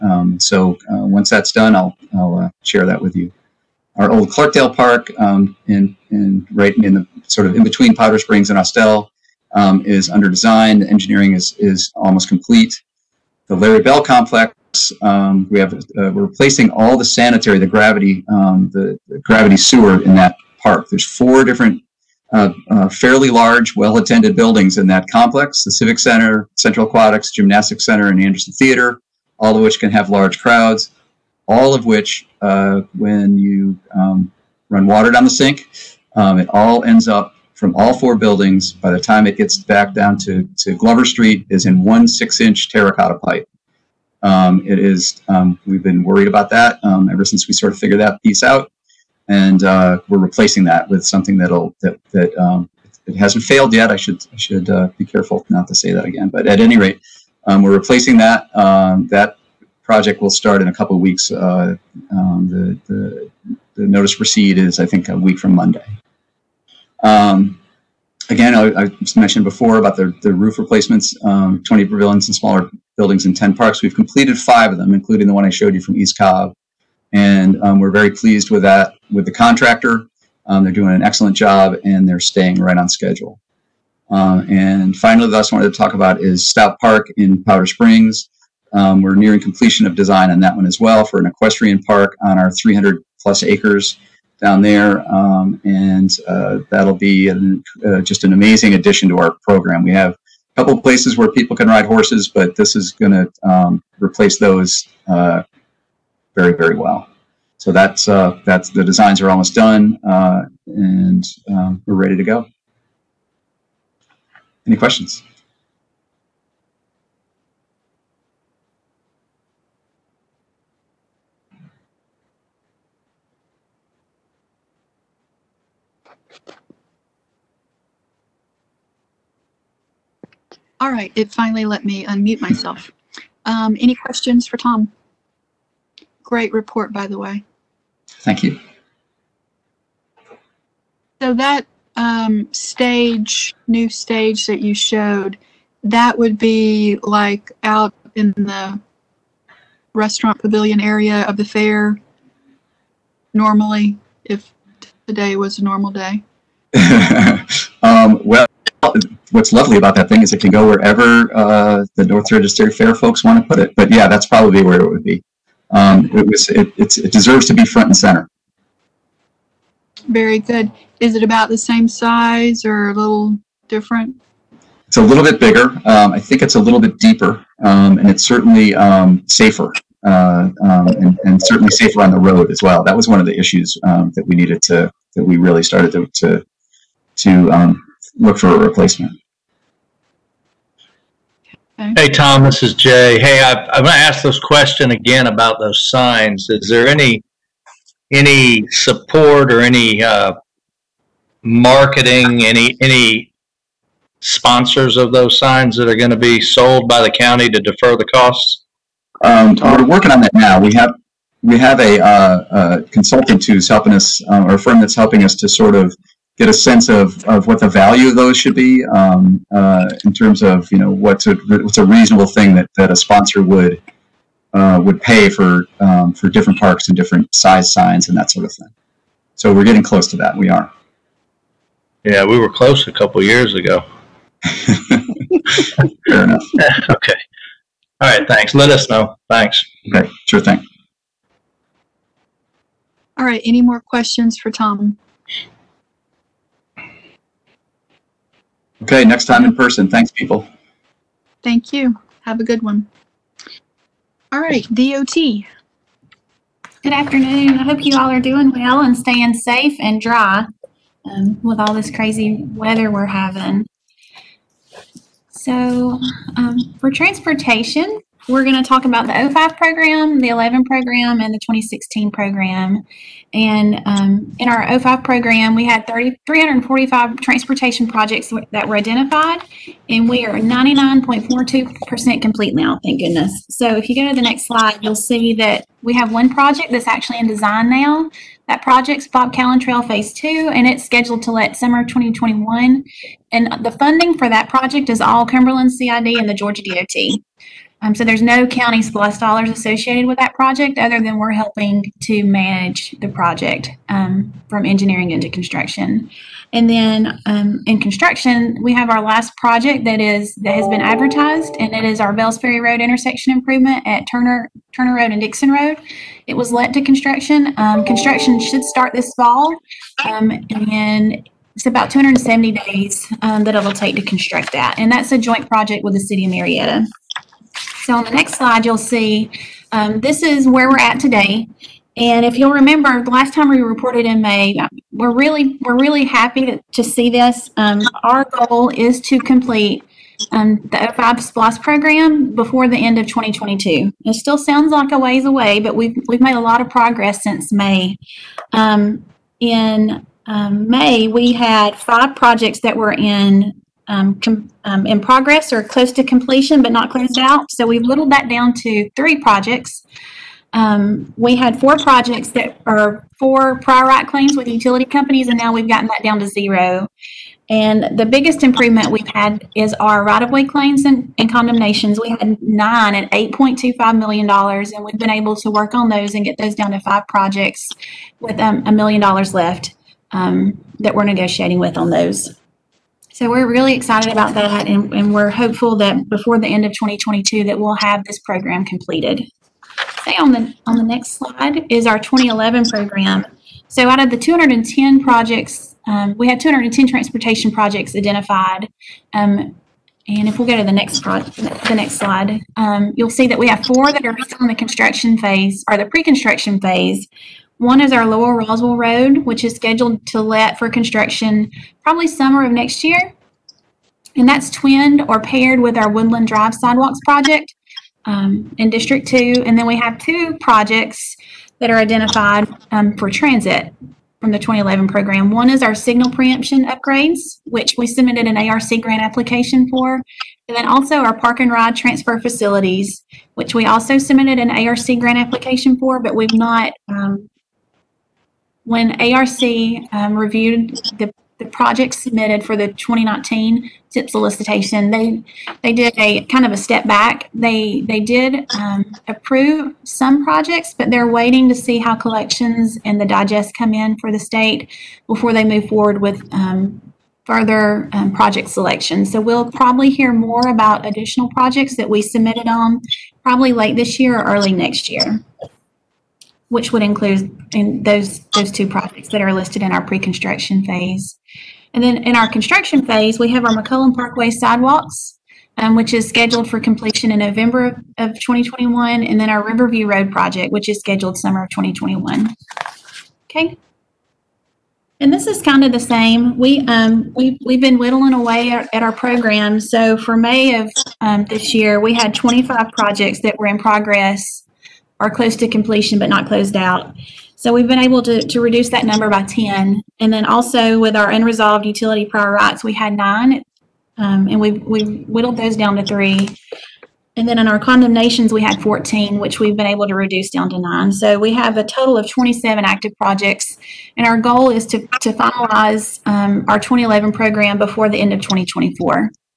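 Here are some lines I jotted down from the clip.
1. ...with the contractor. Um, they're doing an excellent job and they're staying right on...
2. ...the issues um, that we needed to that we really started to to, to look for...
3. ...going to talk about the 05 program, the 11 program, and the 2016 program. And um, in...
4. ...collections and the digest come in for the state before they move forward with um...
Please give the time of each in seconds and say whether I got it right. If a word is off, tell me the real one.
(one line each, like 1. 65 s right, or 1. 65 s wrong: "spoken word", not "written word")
1. 79 s right
2. 183 s right
3. 268 s right
4. 451 s right.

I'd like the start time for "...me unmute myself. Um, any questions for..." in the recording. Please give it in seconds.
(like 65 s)
131 s.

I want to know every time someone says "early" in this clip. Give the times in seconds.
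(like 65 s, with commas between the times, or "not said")
464 s.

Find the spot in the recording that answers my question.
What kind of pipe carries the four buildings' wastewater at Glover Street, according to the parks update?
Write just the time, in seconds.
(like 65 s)
42 s.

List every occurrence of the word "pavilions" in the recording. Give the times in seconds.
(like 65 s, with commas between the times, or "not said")
71 s, 150 s.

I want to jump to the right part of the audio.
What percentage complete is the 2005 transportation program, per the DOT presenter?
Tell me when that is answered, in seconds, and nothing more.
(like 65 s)
280 s.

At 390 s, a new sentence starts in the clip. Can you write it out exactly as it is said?
Say on the on the next slide is our 2011 program.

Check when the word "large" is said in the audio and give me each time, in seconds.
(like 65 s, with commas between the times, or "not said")
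23 s, 30 s.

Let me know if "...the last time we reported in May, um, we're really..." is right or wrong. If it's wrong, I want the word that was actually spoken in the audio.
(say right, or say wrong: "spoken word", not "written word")
right.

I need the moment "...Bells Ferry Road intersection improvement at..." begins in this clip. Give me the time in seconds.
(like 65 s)
312 s.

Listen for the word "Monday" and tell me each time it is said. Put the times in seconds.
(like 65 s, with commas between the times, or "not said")
65 s.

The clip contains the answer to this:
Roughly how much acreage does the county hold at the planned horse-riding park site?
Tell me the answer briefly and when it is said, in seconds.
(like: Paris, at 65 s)
300 plus acres, at 92 s.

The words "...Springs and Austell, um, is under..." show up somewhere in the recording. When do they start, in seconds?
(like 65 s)
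8 s.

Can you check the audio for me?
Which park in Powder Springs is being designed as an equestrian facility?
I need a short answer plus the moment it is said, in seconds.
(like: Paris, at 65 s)
Stout Park, at 86 s.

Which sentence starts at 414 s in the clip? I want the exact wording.
And that's twinned or paired with our Woodland Drive Sidewalks project um, in District 2.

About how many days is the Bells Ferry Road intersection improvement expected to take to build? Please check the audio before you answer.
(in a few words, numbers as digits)
270.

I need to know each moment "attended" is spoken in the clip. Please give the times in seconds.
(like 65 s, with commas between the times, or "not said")
23 s.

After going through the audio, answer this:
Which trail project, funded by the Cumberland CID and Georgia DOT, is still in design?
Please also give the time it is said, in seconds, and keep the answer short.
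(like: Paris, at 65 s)
Bob Callan Trail Phase 2, at 289 s.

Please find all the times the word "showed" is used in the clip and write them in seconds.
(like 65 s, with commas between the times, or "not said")
75 s, 144 s.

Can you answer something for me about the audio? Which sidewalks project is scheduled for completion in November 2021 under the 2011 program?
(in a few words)
McCollum Parkway sidewalks.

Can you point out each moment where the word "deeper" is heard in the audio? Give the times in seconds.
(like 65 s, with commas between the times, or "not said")
176 s.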